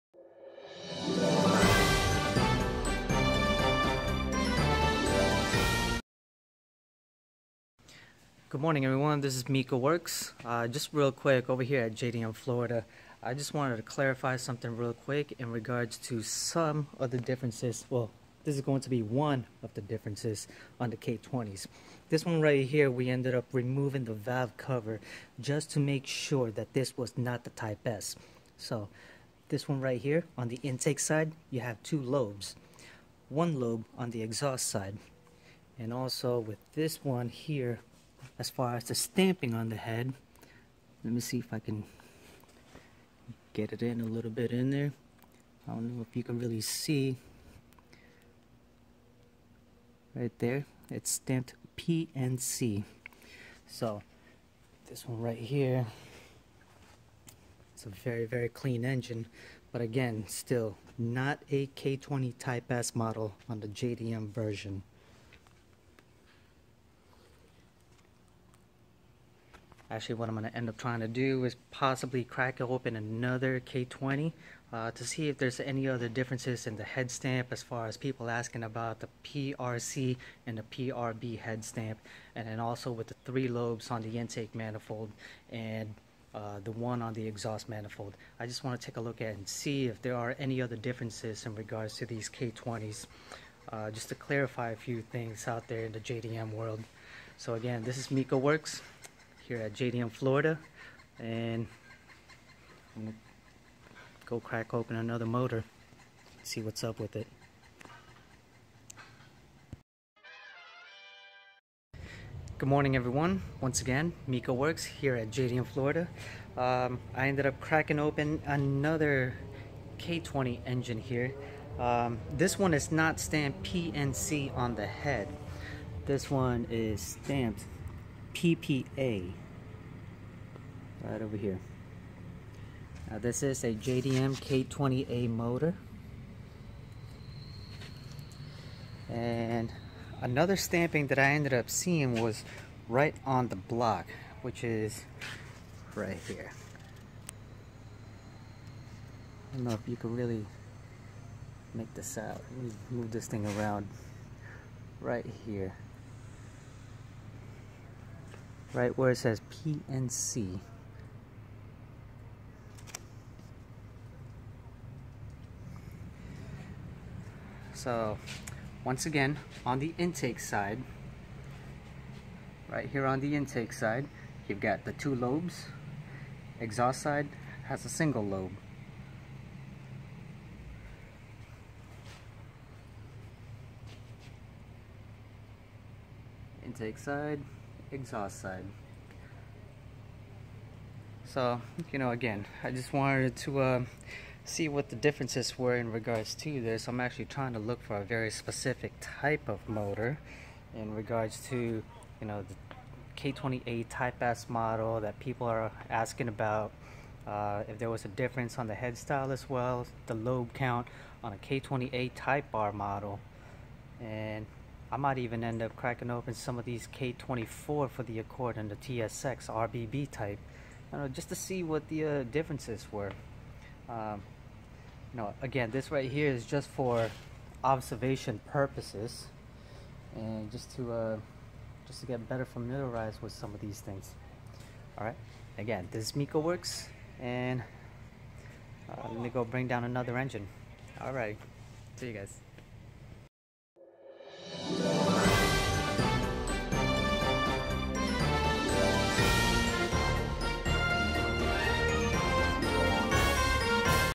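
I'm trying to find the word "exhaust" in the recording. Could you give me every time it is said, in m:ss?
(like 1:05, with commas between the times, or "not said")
0:34, 1:27, 2:56, 3:07.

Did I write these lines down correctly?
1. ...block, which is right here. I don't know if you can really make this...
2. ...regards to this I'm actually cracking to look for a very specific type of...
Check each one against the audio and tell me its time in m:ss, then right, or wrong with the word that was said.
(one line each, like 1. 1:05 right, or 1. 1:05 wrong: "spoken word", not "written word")
1. 2:23 right
2. 3:15 wrong: "trying", not "cracking".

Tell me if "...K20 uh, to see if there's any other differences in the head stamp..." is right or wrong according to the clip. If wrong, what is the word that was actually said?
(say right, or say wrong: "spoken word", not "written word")
right.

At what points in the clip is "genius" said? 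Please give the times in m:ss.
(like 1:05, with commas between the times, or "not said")
not said.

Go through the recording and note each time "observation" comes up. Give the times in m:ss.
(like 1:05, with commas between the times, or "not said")
3:47.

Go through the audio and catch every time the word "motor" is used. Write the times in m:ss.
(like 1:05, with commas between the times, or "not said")
1:45, 2:15, 3:19.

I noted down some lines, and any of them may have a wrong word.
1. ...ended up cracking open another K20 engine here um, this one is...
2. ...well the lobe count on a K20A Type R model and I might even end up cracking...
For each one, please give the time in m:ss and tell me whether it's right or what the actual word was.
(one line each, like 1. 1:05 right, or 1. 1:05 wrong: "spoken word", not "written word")
1. 1:57 right
2. 3:29 right.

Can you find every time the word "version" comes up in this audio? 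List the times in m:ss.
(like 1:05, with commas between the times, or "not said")
1:04.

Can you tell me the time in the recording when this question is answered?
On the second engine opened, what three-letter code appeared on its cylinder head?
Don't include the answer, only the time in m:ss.
2:08.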